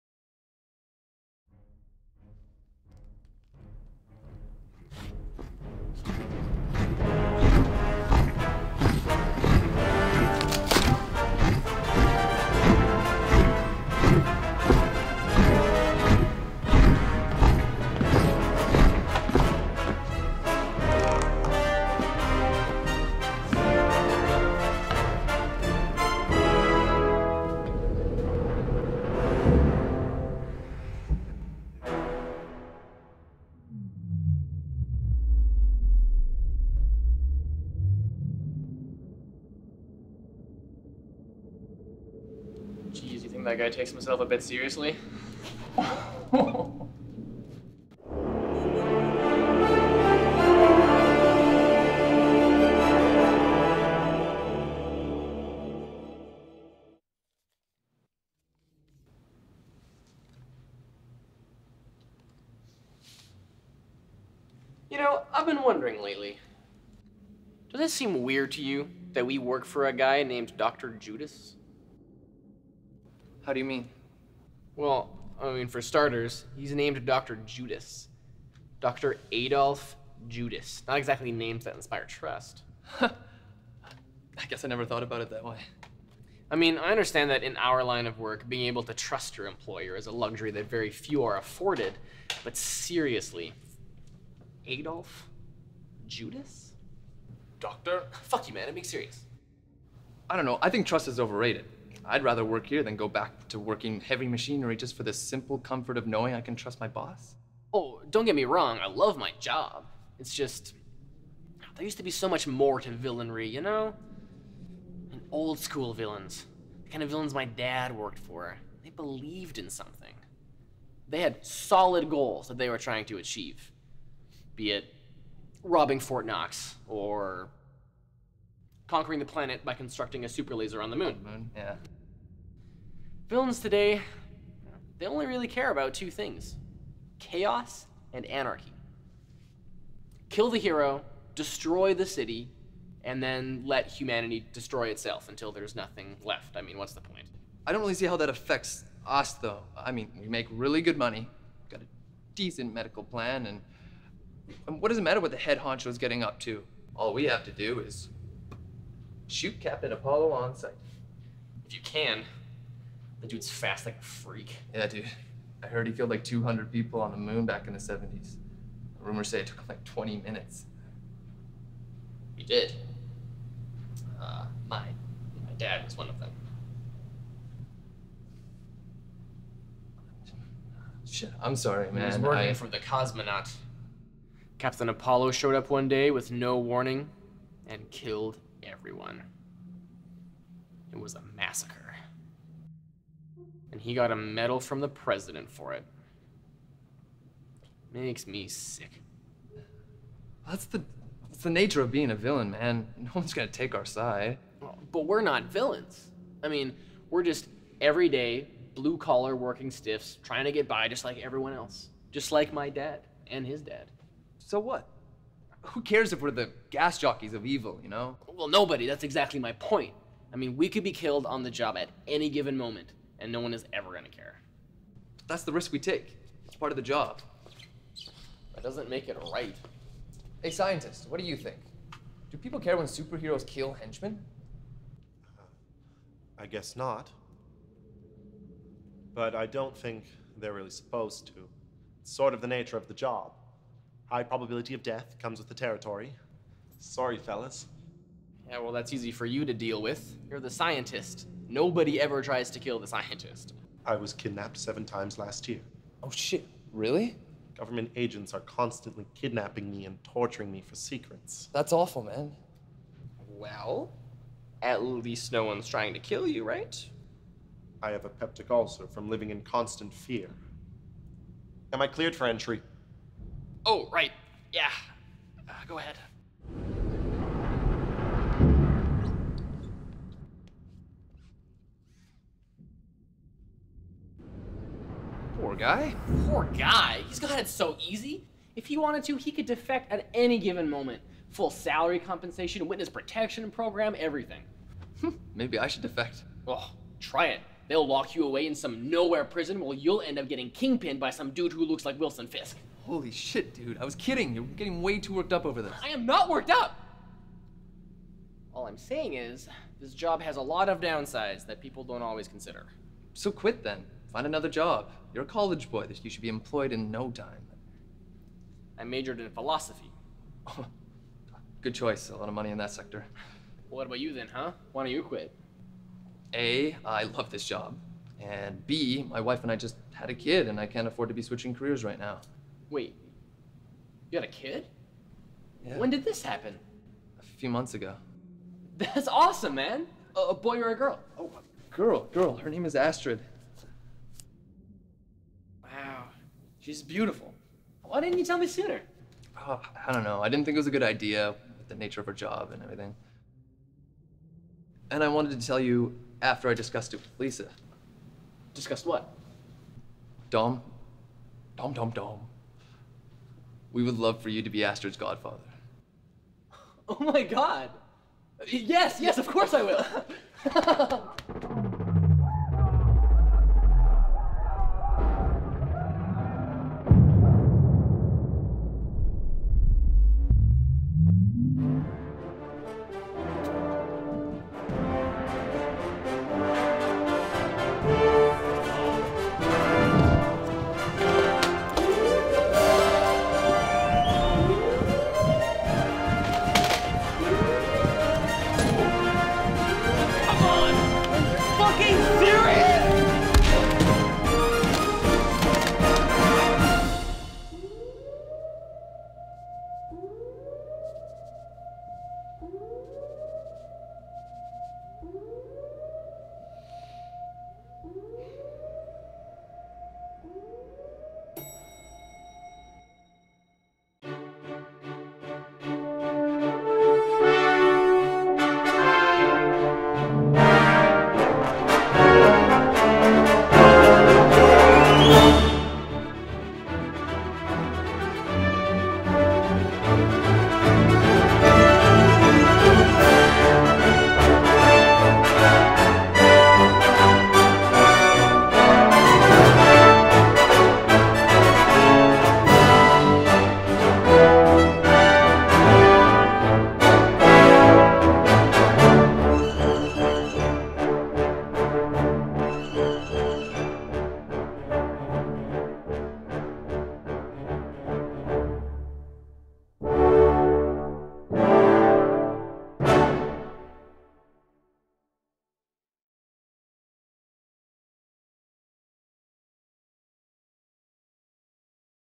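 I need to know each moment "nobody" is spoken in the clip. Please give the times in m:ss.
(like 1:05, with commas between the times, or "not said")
3:38, 4:11.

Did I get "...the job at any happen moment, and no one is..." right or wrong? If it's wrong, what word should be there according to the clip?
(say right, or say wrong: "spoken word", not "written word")
wrong: "given", not "happen".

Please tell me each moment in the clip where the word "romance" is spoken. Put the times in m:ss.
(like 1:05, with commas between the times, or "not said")
not said.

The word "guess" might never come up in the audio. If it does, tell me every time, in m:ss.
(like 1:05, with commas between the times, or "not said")
1:24, 3:56.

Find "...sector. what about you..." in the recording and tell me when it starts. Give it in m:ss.
5:22.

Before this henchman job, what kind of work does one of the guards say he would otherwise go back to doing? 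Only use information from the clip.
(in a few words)
Heavy machinery.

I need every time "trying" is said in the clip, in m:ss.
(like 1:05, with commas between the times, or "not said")
2:02, 3:30, 4:25.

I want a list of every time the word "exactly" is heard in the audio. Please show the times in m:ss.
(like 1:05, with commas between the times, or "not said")
1:20, 3:39.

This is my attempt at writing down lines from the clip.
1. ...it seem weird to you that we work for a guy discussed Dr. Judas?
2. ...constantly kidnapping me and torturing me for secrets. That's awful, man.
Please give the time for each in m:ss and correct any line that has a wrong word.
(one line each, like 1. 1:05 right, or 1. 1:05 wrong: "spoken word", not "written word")
1. 1:07 wrong: "named", not "discussed"
2. 4:18 right.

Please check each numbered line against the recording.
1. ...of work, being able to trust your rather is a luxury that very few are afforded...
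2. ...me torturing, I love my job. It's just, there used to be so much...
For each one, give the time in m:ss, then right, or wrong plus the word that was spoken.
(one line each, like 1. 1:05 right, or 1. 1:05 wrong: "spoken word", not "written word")
1. 1:28 wrong: "employer", not "rather"
2. 1:48 wrong: "wrong", not "torturing".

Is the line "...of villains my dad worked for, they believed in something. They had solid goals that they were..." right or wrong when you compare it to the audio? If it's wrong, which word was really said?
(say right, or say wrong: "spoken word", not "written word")
right.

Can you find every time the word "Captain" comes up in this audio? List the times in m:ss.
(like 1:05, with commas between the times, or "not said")
2:39, 3:04.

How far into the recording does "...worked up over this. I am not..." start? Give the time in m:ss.
5:05.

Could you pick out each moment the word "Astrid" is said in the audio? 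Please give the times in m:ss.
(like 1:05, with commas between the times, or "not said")
5:42, 6:04.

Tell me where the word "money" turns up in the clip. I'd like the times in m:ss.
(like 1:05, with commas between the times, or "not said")
2:30, 5:22.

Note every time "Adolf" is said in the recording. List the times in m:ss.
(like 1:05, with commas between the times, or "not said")
1:19, 1:34.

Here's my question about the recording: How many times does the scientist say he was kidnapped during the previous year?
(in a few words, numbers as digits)
7.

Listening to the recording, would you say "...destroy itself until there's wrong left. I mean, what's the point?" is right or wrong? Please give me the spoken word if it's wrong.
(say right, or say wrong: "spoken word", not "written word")
wrong: "nothing", not "wrong".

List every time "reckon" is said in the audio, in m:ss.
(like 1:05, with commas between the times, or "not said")
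not said.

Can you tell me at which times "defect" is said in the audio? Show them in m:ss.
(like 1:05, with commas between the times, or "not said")
4:49, 4:55.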